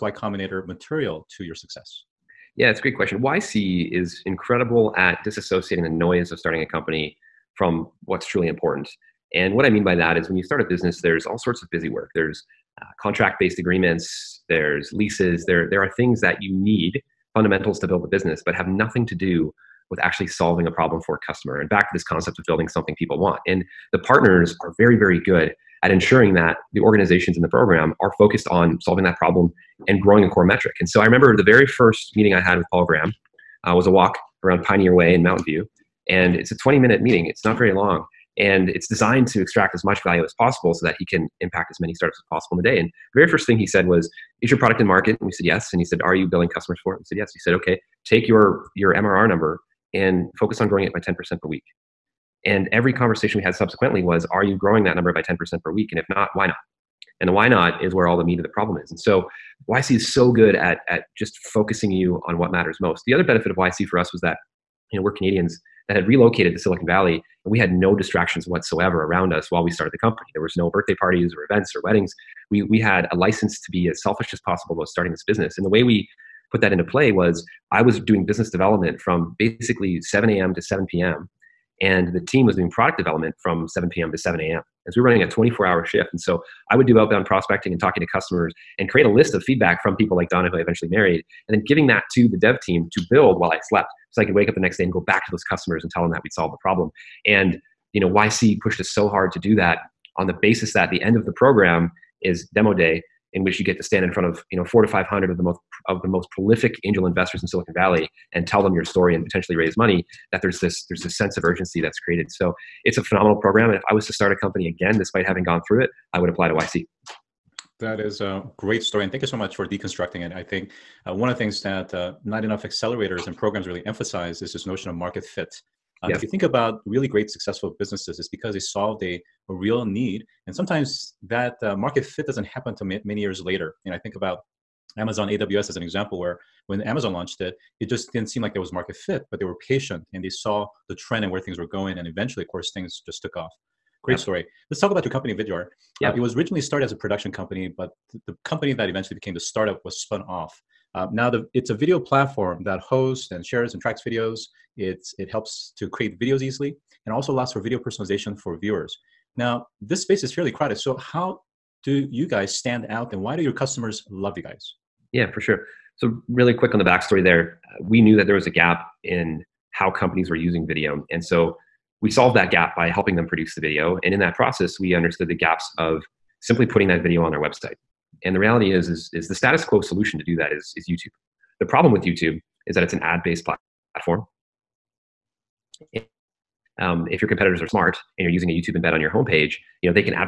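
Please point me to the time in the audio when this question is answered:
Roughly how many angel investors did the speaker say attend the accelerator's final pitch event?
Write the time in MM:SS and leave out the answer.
01:44.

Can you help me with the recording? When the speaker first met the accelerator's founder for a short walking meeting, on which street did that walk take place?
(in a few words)
Pioneer Way.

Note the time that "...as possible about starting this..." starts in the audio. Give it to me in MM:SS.
01:14.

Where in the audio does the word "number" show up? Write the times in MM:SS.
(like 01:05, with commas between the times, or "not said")
00:49, 00:54.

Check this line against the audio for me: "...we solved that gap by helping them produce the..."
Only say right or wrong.
right.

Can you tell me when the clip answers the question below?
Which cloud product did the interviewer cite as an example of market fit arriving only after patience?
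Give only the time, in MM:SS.
02:14.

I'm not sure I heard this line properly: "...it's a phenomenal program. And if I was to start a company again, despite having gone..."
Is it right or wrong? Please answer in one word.
right.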